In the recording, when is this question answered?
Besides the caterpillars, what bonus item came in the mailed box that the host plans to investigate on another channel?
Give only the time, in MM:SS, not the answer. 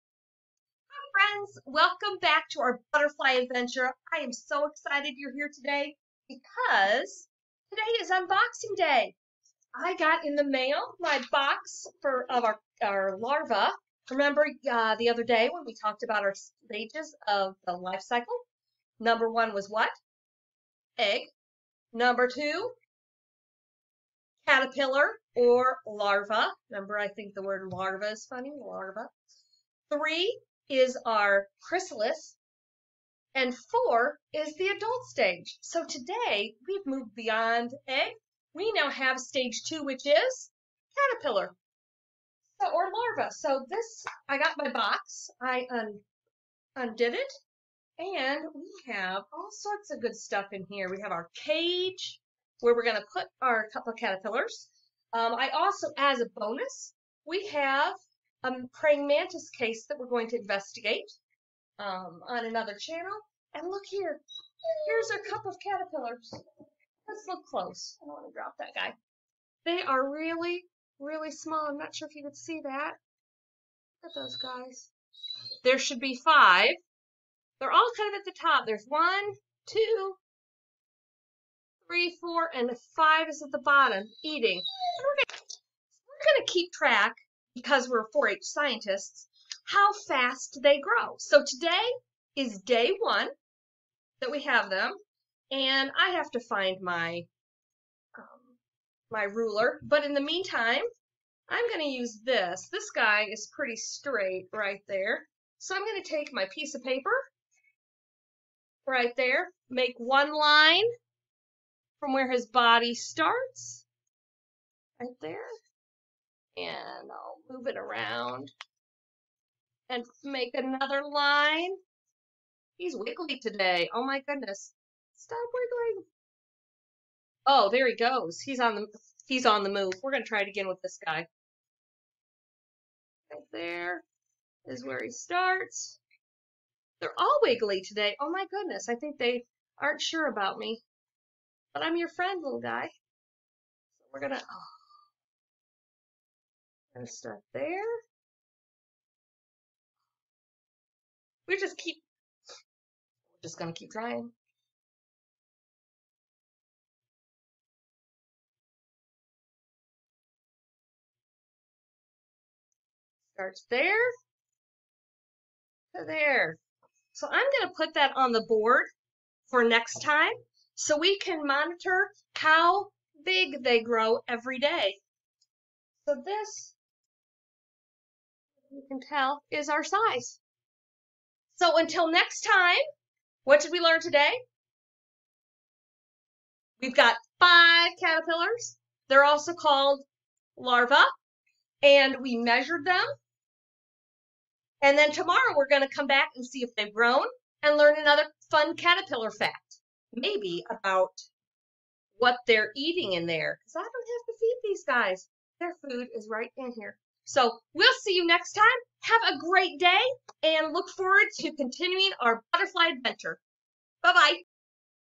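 00:58.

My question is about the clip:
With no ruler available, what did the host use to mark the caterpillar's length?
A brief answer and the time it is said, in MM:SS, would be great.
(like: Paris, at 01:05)
piece of paper, at 01:46.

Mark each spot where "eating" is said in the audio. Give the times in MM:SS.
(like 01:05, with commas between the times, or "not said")
01:24, 03:22.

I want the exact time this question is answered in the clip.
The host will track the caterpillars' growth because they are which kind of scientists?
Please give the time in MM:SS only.
01:28.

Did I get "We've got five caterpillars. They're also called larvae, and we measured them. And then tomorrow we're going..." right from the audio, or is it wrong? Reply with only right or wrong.
right.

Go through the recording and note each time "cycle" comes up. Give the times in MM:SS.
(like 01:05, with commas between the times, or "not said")
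00:18.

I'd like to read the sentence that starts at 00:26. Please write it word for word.
Remember, I think the word larva is funny, larva.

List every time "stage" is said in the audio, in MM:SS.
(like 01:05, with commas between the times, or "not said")
00:16, 00:35, 00:39.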